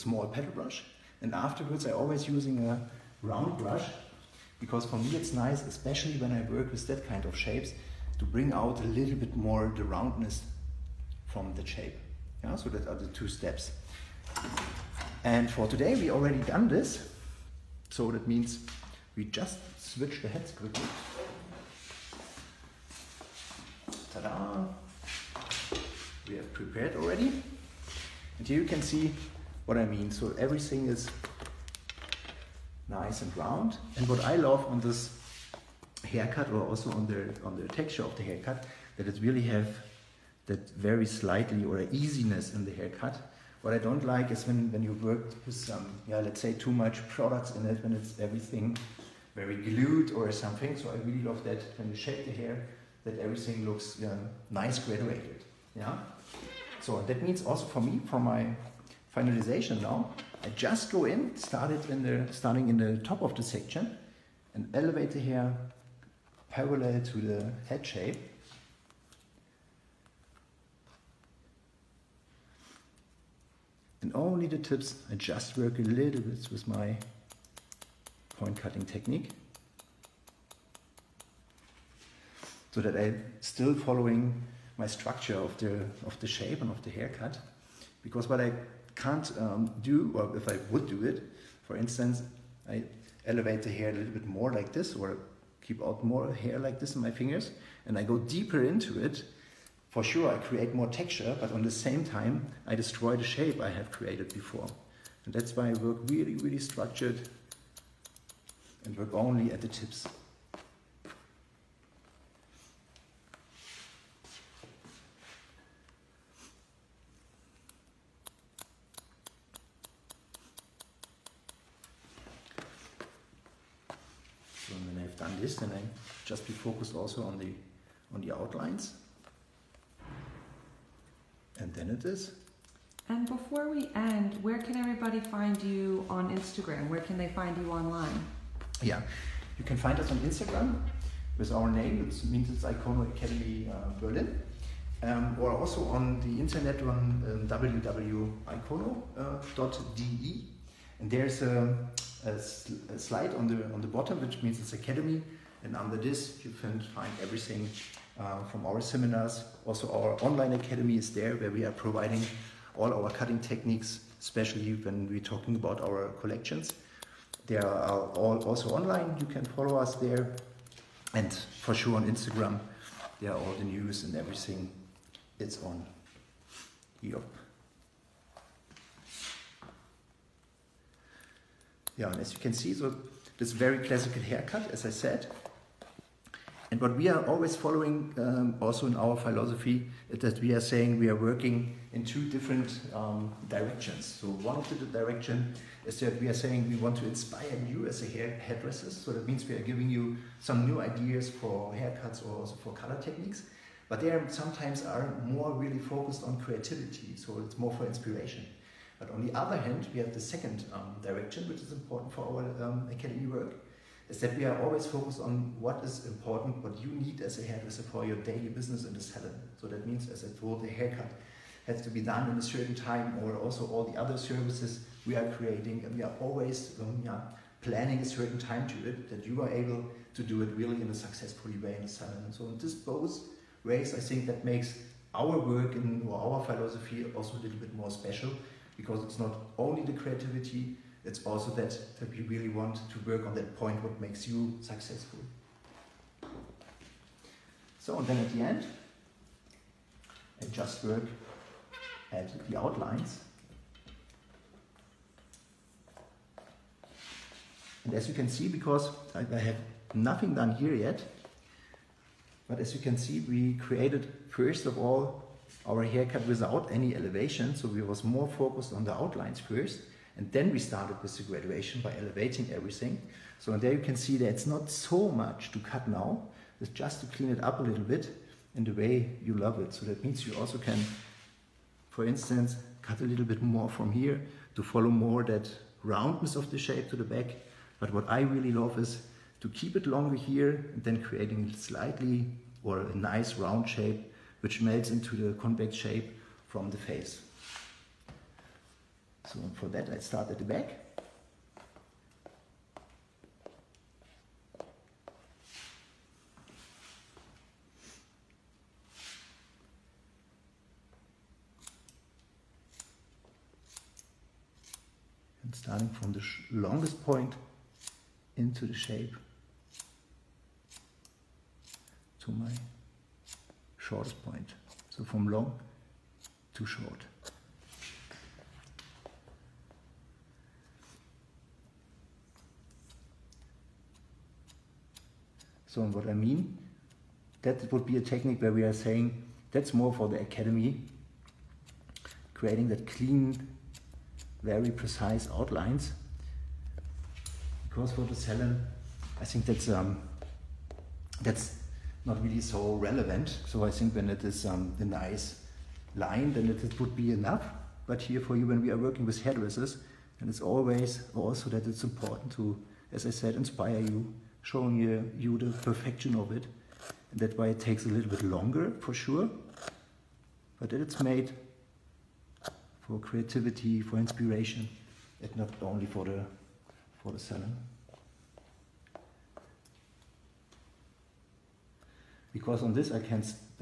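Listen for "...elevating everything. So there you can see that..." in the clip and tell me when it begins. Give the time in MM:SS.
04:31.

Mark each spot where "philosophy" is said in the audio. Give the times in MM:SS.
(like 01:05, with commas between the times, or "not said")
03:09, 03:56.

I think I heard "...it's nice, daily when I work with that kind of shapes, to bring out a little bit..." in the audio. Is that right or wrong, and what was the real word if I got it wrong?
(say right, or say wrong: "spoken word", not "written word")
wrong: "especially", not "daily".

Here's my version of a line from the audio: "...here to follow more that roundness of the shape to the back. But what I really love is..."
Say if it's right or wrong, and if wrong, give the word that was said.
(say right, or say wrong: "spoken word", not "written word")
right.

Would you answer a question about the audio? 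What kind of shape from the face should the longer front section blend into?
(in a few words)
convex.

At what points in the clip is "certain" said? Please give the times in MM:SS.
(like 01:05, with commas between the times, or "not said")
03:42, 03:48.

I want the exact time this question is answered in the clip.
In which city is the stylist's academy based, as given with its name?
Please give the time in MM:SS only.
02:23.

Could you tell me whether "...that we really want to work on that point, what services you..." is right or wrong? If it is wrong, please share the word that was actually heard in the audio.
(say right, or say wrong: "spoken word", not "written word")
wrong: "makes", not "services".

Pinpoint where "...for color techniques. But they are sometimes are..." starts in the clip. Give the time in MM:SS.
03:22.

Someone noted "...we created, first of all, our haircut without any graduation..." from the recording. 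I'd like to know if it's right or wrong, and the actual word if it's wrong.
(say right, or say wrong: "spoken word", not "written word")
wrong: "elevation", not "graduation".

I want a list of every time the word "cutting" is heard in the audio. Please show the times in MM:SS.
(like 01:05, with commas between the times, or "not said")
01:18, 02:43.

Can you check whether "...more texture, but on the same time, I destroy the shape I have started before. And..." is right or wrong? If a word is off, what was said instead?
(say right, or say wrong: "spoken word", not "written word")
wrong: "created", not "started".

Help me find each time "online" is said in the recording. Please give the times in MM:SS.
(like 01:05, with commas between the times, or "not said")
02:17, 02:40, 02:48.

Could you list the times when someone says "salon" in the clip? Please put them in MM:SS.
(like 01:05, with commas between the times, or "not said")
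03:39, 03:51, 05:48.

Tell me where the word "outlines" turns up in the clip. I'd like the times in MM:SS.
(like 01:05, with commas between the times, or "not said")
02:08, 04:12, 04:28, 05:45.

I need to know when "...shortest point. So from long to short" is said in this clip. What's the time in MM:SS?
05:23.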